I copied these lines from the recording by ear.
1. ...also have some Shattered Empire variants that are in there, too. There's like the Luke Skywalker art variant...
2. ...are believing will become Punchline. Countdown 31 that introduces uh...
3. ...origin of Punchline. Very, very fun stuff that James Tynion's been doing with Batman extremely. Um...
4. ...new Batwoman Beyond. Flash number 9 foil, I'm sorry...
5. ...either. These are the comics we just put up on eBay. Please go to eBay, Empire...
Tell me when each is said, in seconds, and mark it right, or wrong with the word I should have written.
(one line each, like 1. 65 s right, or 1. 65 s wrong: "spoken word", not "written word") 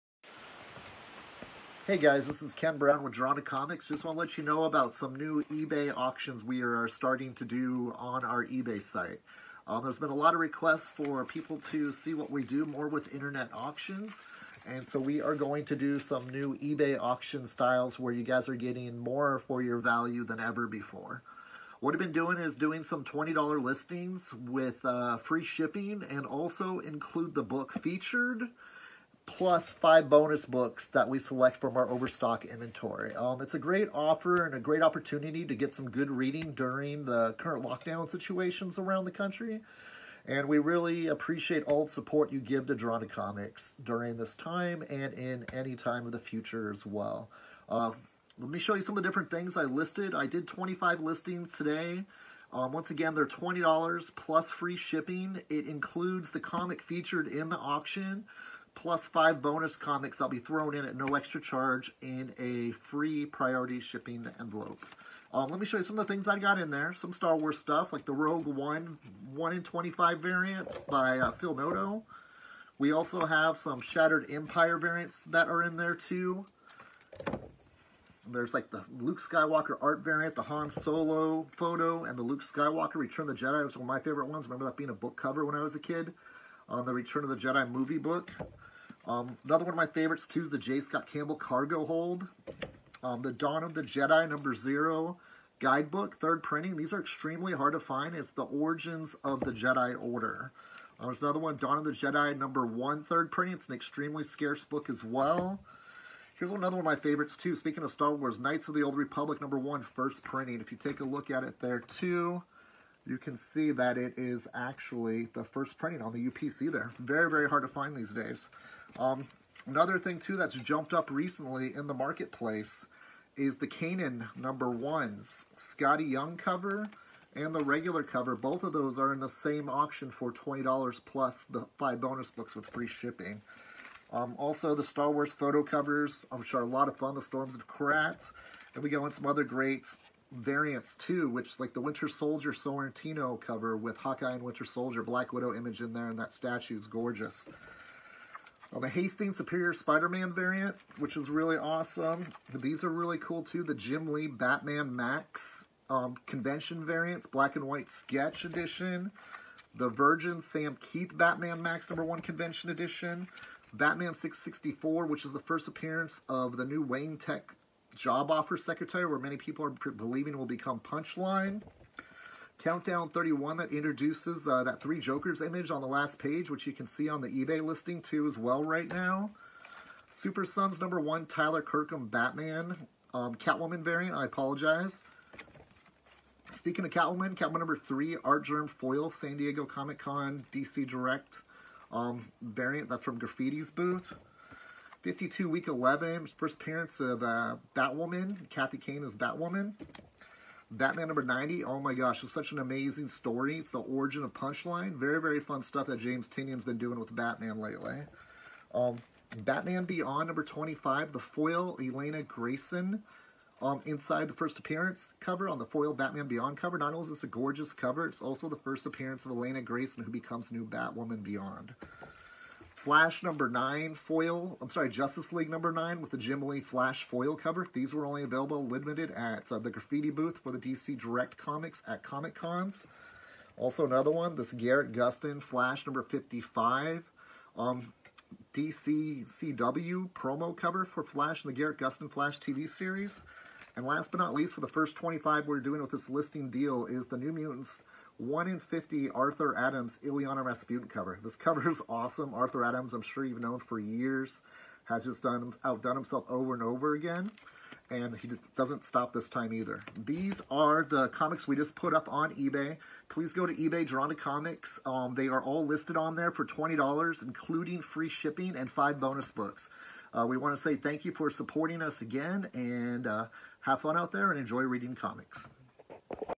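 1. 72 s right
2. 169 s right
3. 203 s wrong: "lately", not "extremely"
4. 220 s right
5. 259 s wrong: "Drawn", not "Empire".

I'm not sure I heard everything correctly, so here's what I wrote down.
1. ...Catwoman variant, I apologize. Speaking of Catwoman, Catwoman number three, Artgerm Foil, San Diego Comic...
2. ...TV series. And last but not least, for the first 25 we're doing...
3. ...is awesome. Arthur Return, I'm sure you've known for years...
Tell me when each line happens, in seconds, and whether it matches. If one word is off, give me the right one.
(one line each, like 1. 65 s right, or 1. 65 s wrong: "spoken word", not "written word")
1. 183 s right
2. 242 s right
3. 251 s wrong: "Adams", not "Return".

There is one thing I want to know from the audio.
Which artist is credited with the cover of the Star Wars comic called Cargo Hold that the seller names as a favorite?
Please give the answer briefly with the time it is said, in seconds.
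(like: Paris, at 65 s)
J. Scott Campbell, at 90 s.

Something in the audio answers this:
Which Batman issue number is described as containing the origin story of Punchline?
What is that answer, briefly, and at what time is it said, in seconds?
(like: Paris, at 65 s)
90, at 200 s.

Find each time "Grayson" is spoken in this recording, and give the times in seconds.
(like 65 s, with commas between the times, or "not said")
212 s, 219 s.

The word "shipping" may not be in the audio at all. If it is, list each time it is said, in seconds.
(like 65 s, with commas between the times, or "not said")
25 s, 54 s, 63 s, 132 s, 268 s.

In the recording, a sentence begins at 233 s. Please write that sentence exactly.
Also another one, this Grant Gustin Flash number 55.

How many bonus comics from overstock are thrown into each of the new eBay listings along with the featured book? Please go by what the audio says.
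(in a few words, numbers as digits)
5.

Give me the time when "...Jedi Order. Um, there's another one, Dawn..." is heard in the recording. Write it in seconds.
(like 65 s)
99 s.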